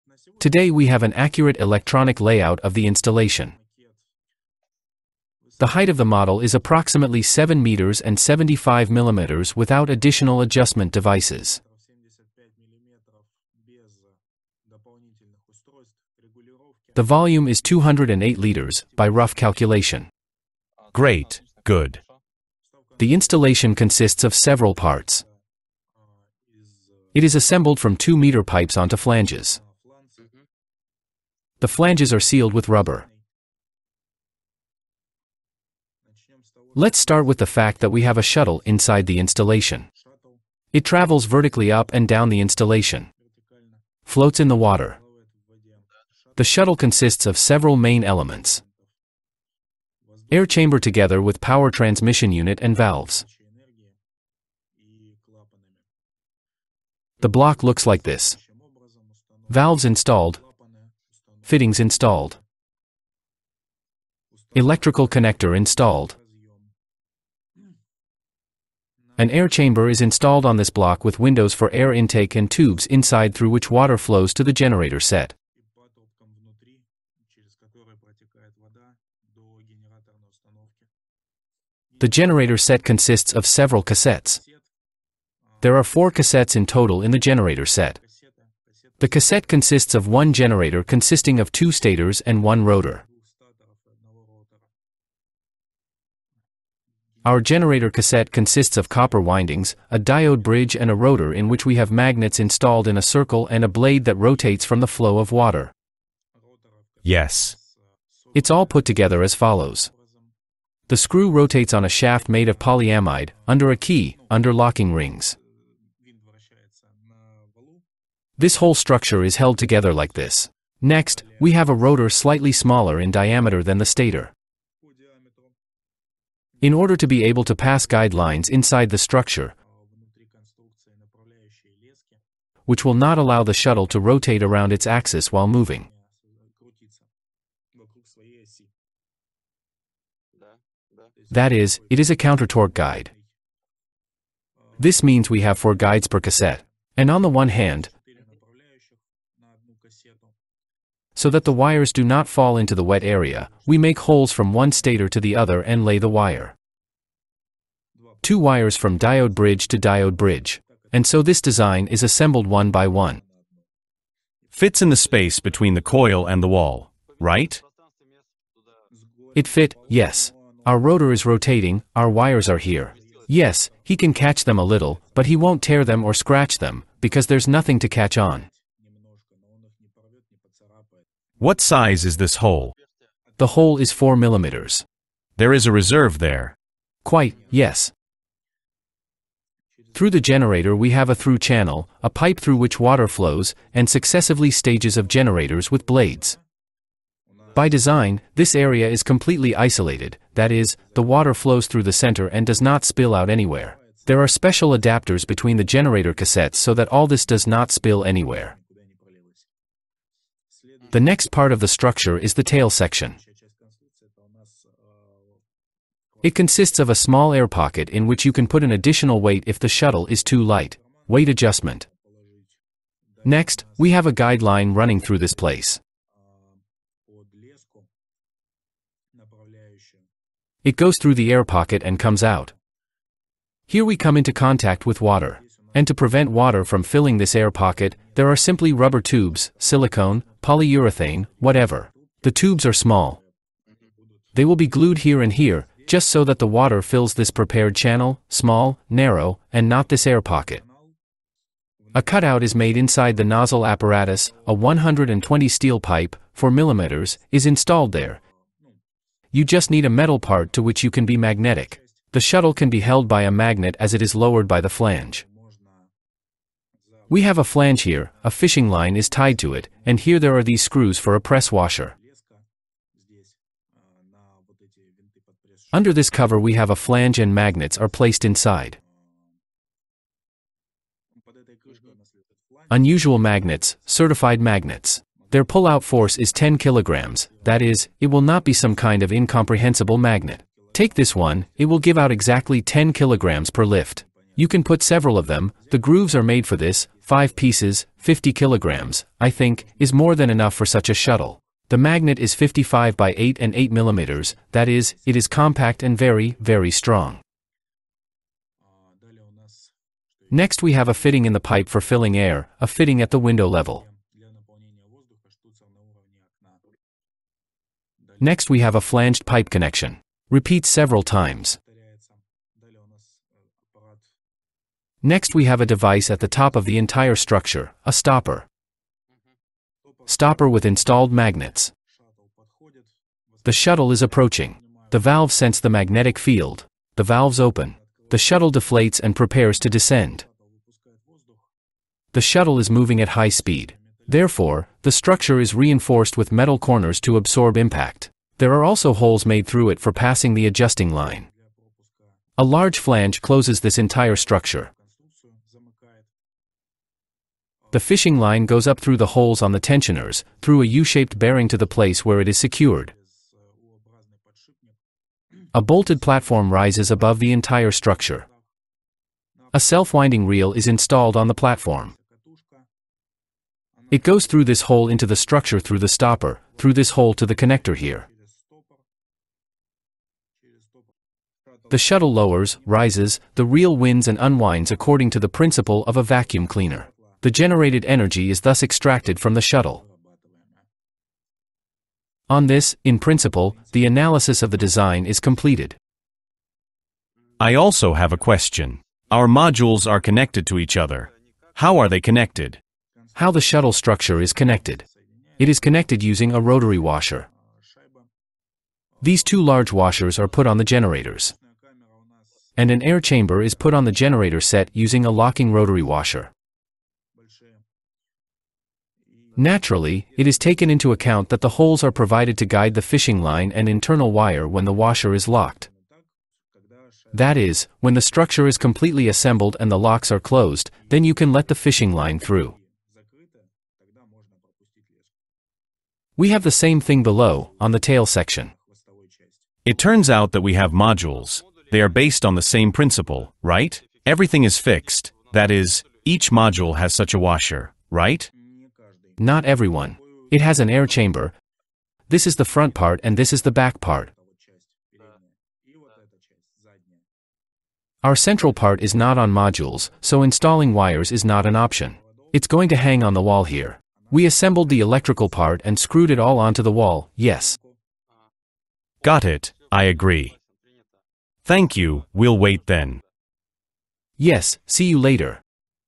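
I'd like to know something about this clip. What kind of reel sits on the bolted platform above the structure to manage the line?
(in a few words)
Self-winding reel.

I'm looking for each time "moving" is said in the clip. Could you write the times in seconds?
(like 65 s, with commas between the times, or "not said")
135 s, 342 s.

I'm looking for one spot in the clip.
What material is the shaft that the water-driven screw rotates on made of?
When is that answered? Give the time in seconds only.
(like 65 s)
112 s.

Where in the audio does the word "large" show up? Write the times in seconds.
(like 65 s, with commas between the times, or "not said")
352 s, 409 s.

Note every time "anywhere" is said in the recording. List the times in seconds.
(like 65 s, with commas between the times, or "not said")
203 s, 208 s.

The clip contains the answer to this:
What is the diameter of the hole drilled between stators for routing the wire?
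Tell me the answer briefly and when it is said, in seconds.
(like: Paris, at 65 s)
4 millimeters, at 183 s.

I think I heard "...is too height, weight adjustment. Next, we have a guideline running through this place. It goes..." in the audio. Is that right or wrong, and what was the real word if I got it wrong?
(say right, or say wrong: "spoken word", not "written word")
wrong: "light", not "height".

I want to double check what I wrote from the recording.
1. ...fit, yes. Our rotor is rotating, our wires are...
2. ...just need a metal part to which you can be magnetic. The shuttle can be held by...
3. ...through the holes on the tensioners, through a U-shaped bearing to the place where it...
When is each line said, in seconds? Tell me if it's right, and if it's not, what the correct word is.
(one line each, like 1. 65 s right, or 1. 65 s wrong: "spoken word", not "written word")
1. 169 s right
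2. 259 s right
3. 358 s right.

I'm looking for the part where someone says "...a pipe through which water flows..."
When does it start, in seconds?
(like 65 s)
192 s.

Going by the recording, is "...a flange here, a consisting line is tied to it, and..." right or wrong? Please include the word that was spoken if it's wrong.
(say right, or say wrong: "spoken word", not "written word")
wrong: "fishing", not "consisting".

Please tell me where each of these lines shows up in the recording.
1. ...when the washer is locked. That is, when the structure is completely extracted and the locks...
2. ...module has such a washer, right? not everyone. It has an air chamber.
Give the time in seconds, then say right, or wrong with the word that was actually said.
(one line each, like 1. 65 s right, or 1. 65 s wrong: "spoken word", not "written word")
1. 424 s wrong: "assembled", not "extracted"
2. 446 s right.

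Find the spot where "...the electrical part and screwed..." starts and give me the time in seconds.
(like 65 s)
464 s.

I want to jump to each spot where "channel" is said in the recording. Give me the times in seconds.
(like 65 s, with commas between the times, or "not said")
191 s, 247 s.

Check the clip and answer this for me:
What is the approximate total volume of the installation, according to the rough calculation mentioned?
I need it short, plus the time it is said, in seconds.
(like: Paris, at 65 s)
208 liters, at 17 s.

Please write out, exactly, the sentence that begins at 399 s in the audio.
Our modules are connected to each other.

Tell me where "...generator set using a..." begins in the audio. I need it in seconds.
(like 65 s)
413 s.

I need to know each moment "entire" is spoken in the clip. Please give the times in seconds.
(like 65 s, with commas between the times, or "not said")
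326 s, 353 s, 367 s.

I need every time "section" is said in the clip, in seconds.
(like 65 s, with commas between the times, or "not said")
212 s, 438 s.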